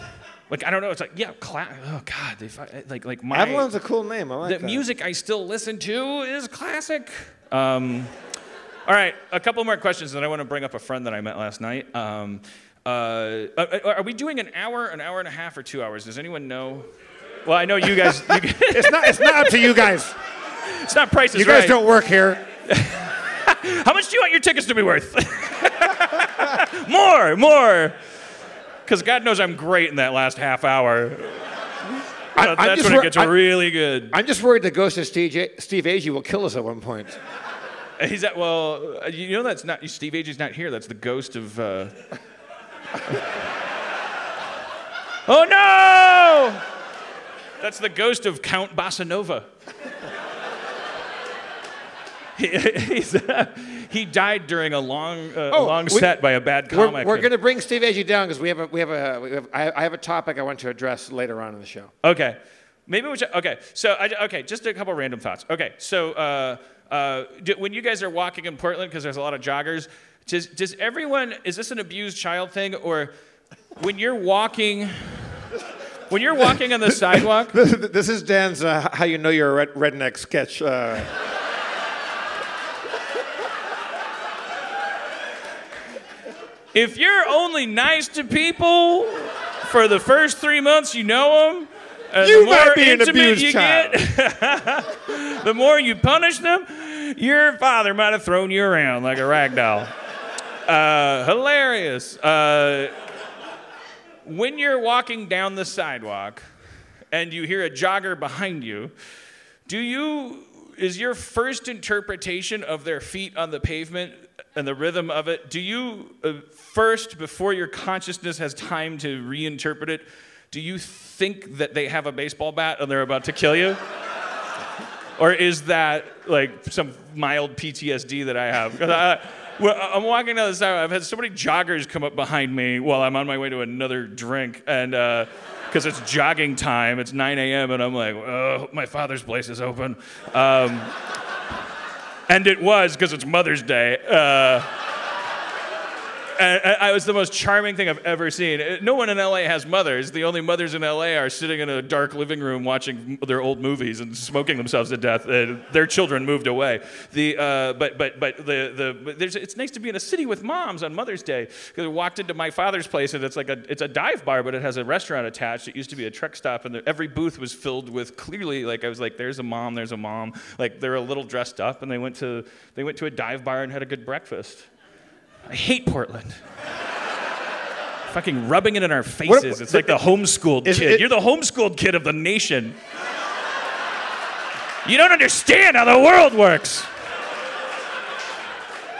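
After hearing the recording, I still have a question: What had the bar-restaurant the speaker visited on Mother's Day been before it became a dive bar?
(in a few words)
A truck stop.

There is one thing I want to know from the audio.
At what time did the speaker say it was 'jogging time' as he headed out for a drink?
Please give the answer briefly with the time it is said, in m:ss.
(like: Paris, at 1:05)
9 a.m., at 2:17.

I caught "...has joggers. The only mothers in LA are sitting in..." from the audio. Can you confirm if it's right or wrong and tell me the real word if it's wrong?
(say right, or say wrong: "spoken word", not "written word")
wrong: "mothers", not "joggers".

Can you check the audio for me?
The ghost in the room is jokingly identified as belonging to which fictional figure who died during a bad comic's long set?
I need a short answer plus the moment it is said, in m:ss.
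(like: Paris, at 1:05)
Count Bassanova, at 0:48.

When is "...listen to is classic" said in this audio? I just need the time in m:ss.
0:05.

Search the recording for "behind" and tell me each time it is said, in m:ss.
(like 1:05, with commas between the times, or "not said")
1:48, 2:12.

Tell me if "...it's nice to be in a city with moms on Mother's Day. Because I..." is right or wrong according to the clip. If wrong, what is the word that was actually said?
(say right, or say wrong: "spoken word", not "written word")
right.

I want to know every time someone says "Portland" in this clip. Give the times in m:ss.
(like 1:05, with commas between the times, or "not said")
1:08, 2:55.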